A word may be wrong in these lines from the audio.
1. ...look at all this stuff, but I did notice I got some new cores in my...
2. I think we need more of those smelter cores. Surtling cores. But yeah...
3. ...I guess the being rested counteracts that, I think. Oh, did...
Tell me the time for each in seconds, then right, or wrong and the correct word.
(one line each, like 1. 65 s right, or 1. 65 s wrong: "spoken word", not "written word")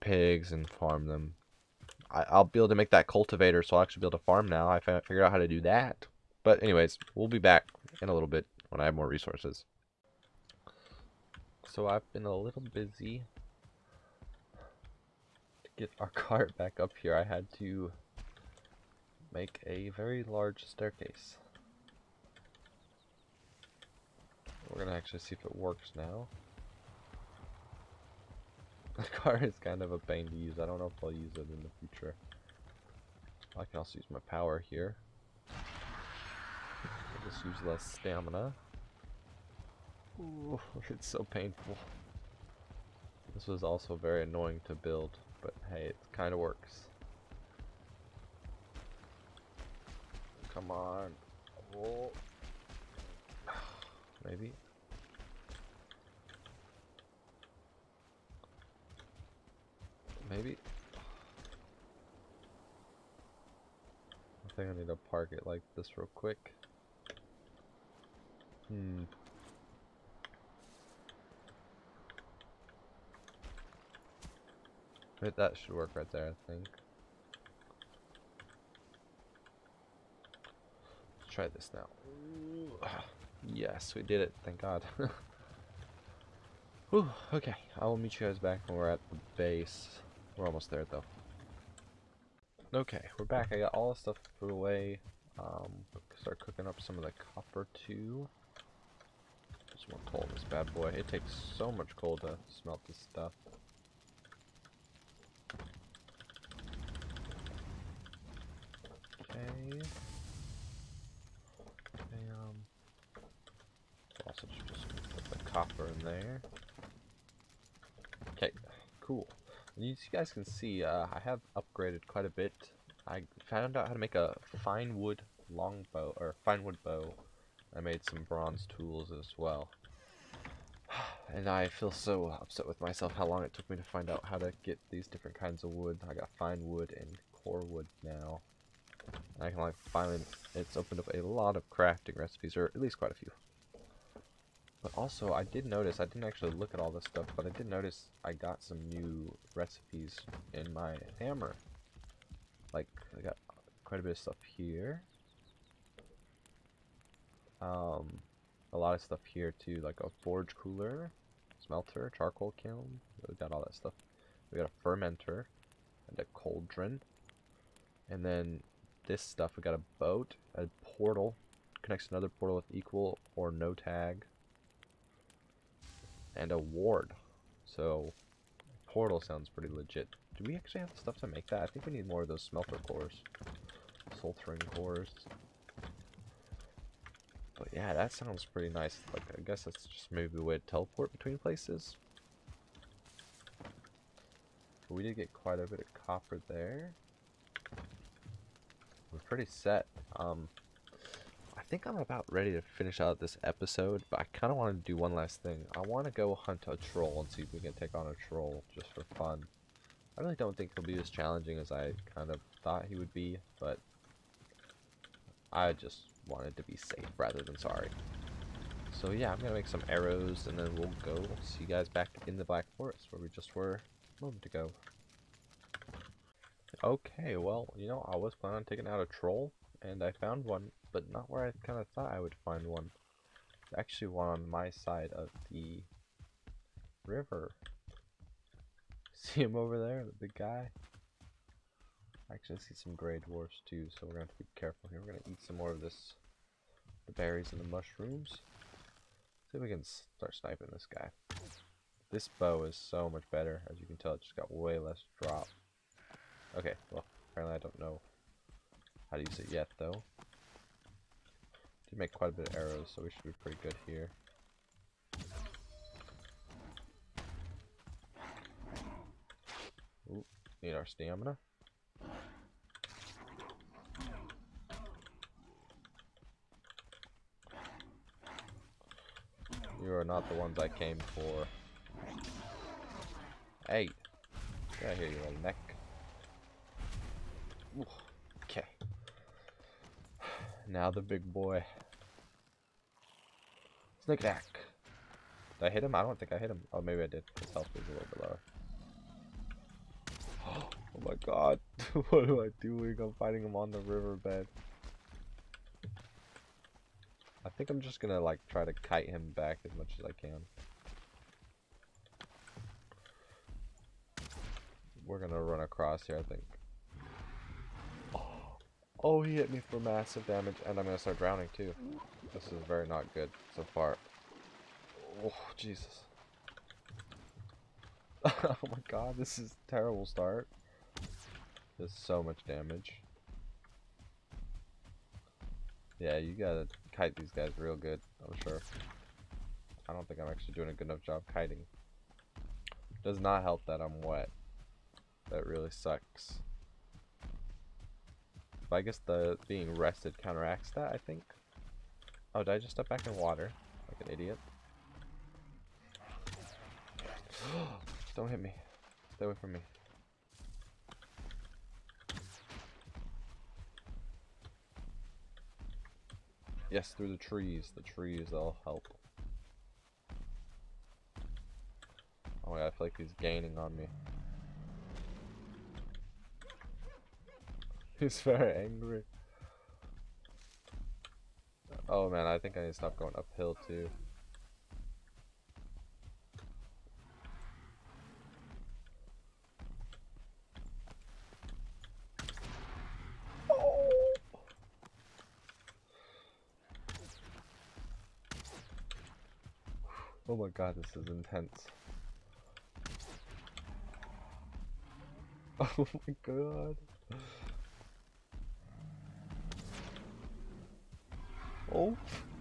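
1. 146 s wrong: "recipes", not "cores"
2. 181 s right
3. 348 s right.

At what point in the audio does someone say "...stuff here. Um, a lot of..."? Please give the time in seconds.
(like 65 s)
154 s.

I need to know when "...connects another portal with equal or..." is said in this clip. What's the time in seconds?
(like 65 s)
171 s.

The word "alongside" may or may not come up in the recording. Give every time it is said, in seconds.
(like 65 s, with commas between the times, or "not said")
not said.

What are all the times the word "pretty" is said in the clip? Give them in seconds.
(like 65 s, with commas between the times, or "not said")
179 s, 188 s, 199 s, 263 s.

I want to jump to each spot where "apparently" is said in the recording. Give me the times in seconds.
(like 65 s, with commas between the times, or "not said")
257 s.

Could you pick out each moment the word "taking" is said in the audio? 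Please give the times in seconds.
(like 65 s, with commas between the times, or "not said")
228 s.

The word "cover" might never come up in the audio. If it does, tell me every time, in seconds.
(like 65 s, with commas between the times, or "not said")
not said.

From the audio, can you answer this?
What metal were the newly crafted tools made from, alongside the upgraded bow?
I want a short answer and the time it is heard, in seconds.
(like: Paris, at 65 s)
bronze, at 128 s.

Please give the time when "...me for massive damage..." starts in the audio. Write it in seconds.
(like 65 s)
319 s.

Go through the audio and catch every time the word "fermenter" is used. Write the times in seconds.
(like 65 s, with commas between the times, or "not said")
164 s.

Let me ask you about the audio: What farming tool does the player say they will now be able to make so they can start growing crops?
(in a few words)
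cultivator.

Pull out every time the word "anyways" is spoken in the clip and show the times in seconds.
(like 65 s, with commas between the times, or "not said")
6 s.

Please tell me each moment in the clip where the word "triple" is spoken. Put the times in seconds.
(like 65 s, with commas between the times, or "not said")
not said.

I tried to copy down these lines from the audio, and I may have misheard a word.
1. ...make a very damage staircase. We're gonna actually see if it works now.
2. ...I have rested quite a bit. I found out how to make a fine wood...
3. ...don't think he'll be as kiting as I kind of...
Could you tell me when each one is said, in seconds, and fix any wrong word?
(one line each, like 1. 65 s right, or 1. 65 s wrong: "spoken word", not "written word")
1. 19 s wrong: "large", not "damage"
2. 121 s wrong: "upgraded", not "rested"
3. 210 s wrong: "challenging", not "kiting".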